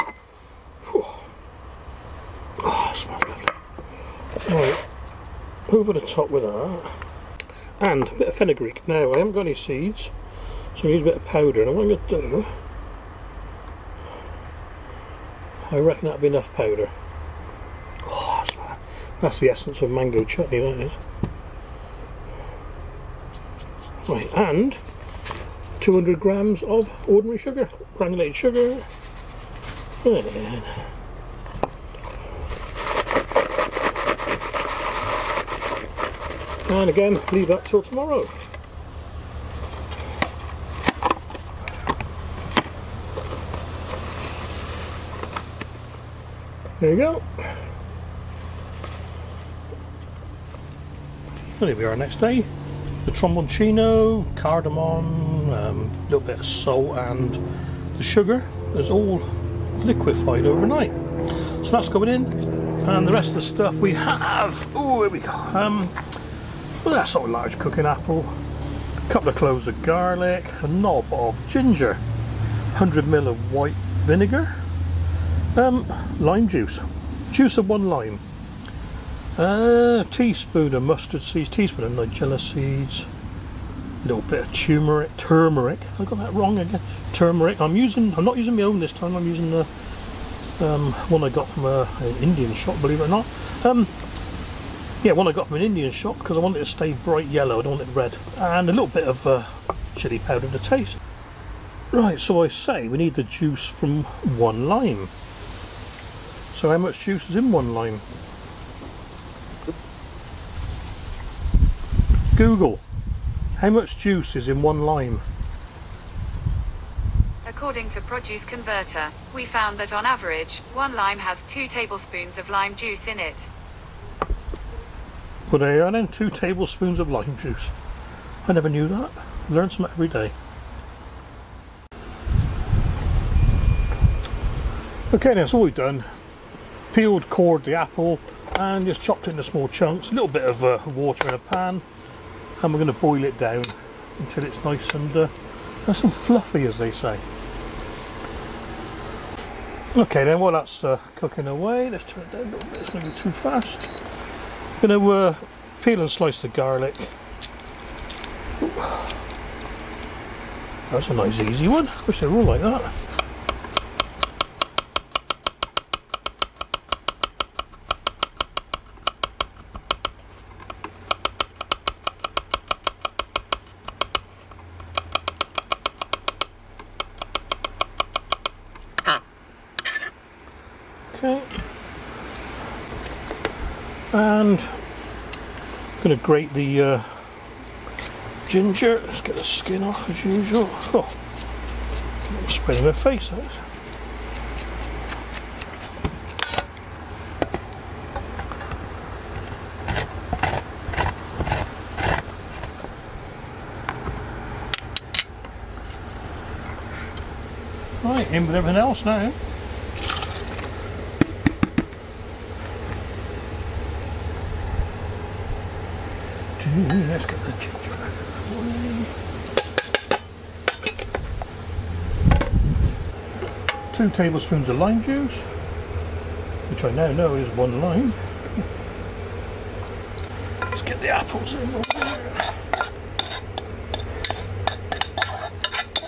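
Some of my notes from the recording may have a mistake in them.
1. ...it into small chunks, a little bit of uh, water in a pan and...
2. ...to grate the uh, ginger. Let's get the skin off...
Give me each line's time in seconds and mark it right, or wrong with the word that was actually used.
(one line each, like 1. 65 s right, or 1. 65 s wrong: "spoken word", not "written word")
1. 139 s right
2. 186 s right.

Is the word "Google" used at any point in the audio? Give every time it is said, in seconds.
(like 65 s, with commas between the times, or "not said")
112 s.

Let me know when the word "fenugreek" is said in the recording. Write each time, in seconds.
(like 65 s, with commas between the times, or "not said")
8 s.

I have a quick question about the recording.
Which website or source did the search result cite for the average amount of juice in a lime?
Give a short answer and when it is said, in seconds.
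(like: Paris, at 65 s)
Produce Converter, at 118 s.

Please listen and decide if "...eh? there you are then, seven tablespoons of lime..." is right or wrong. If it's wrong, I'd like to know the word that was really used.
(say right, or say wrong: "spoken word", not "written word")
wrong: "two", not "seven".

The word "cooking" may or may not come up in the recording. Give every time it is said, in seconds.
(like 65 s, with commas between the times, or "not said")
67 s, 151 s.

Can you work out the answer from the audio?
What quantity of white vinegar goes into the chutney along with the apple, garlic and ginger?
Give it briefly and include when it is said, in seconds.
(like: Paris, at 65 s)
100 ml, at 72 s.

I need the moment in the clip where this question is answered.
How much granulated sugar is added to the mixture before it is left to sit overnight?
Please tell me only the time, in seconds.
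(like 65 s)
25 s.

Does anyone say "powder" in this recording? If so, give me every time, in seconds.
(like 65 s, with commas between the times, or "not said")
11 s, 16 s, 100 s.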